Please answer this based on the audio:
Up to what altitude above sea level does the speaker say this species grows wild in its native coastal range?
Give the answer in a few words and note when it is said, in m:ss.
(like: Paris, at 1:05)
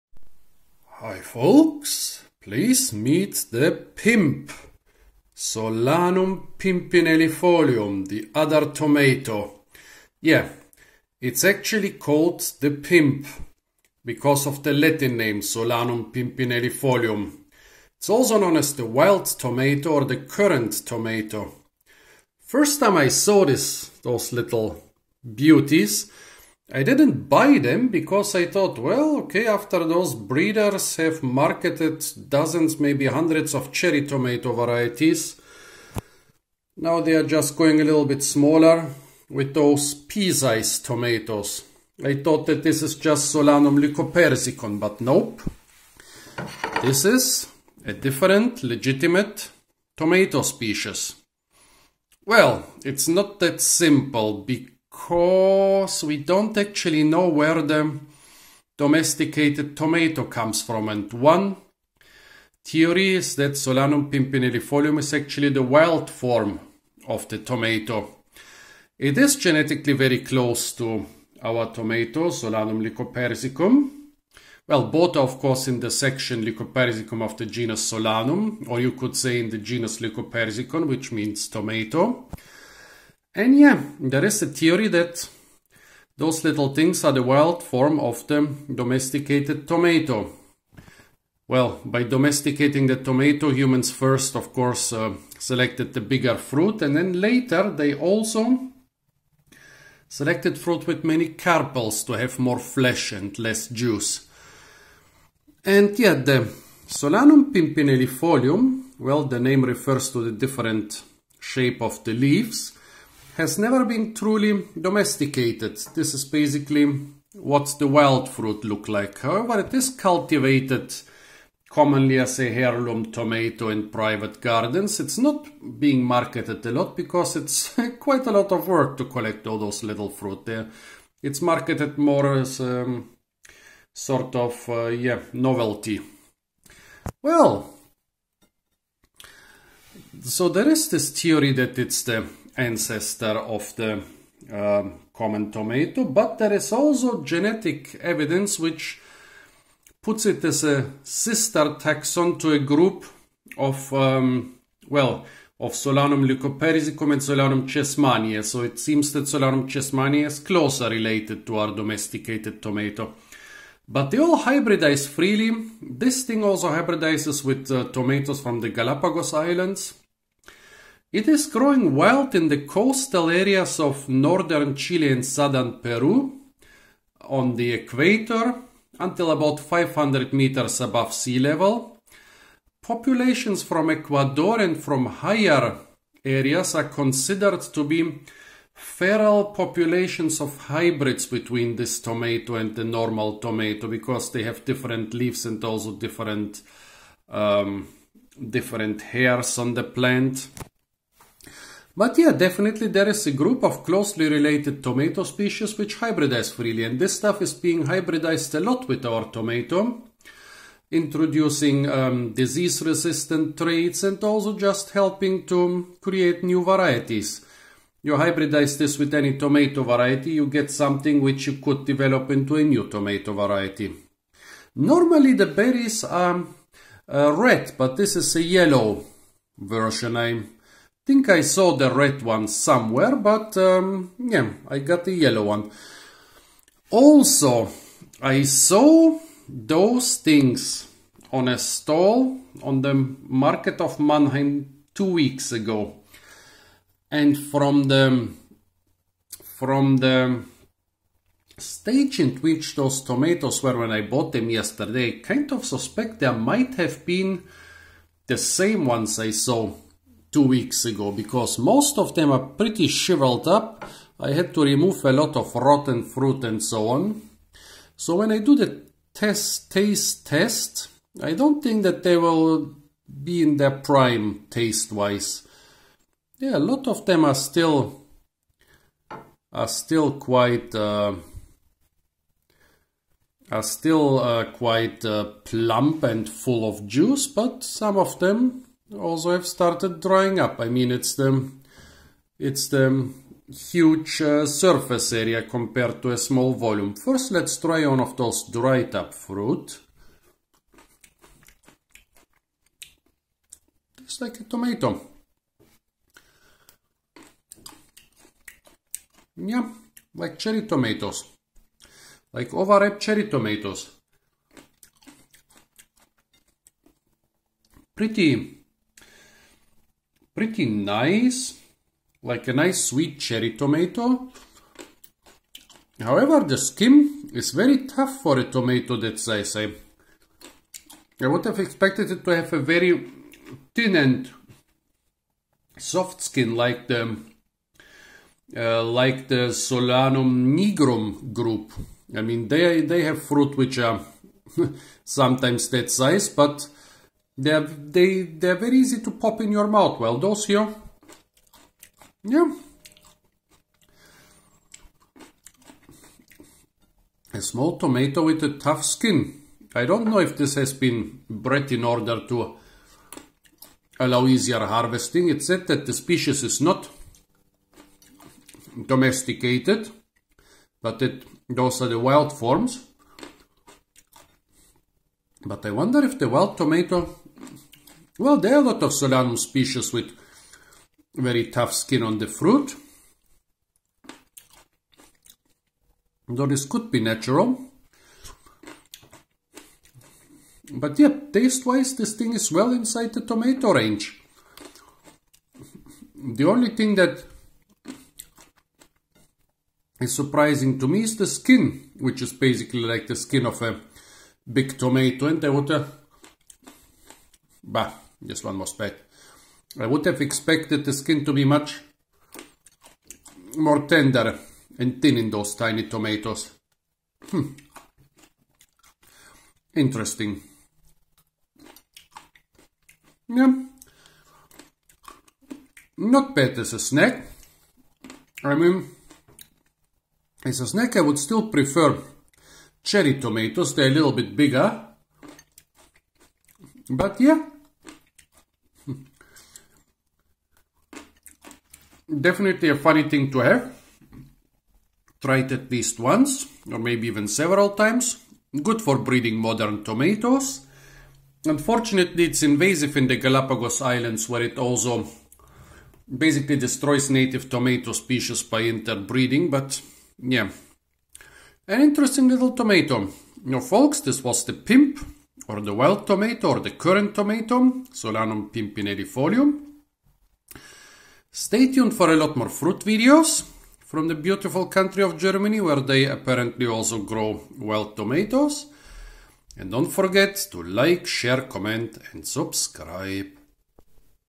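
500 meters, at 2:59.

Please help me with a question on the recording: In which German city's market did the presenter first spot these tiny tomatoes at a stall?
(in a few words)
Mannheim.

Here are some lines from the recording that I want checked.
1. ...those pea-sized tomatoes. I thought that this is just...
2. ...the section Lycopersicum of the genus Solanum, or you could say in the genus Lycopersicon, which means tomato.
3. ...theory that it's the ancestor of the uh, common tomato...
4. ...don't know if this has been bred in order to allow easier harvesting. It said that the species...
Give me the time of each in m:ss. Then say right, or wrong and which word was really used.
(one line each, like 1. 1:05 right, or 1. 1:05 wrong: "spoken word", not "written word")
1. 0:39 right
2. 1:15 right
3. 2:21 right
4. 5:59 right.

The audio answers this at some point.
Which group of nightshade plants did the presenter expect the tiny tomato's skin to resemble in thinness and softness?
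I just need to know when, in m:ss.
5:39.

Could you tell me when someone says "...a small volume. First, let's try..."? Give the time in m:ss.
4:56.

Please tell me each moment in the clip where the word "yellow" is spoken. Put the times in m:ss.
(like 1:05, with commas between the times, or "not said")
3:48, 3:55.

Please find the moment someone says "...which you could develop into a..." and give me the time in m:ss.
3:41.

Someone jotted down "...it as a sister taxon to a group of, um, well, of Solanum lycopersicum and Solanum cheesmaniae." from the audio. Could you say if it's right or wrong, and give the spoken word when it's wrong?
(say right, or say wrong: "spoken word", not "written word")
right.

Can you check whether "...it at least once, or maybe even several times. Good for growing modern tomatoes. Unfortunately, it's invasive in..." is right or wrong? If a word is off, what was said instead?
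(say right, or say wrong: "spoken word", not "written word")
wrong: "breeding", not "growing".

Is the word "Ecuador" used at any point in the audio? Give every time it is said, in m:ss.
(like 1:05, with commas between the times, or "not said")
3:03.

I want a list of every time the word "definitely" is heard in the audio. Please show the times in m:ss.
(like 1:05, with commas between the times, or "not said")
3:22, 7:22.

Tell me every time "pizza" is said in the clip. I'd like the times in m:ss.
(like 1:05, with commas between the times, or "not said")
not said.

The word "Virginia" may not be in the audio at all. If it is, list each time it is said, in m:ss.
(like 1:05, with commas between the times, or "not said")
not said.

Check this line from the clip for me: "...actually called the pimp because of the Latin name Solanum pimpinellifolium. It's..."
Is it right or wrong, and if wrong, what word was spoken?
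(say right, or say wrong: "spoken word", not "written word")
right.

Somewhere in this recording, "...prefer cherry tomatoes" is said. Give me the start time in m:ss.
7:11.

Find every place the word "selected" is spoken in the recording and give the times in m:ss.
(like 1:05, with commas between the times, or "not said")
1:35, 1:40.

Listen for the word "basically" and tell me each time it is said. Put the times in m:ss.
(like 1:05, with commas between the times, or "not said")
1:56, 6:42, 7:36.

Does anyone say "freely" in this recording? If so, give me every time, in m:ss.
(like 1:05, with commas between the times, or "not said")
2:45, 3:26.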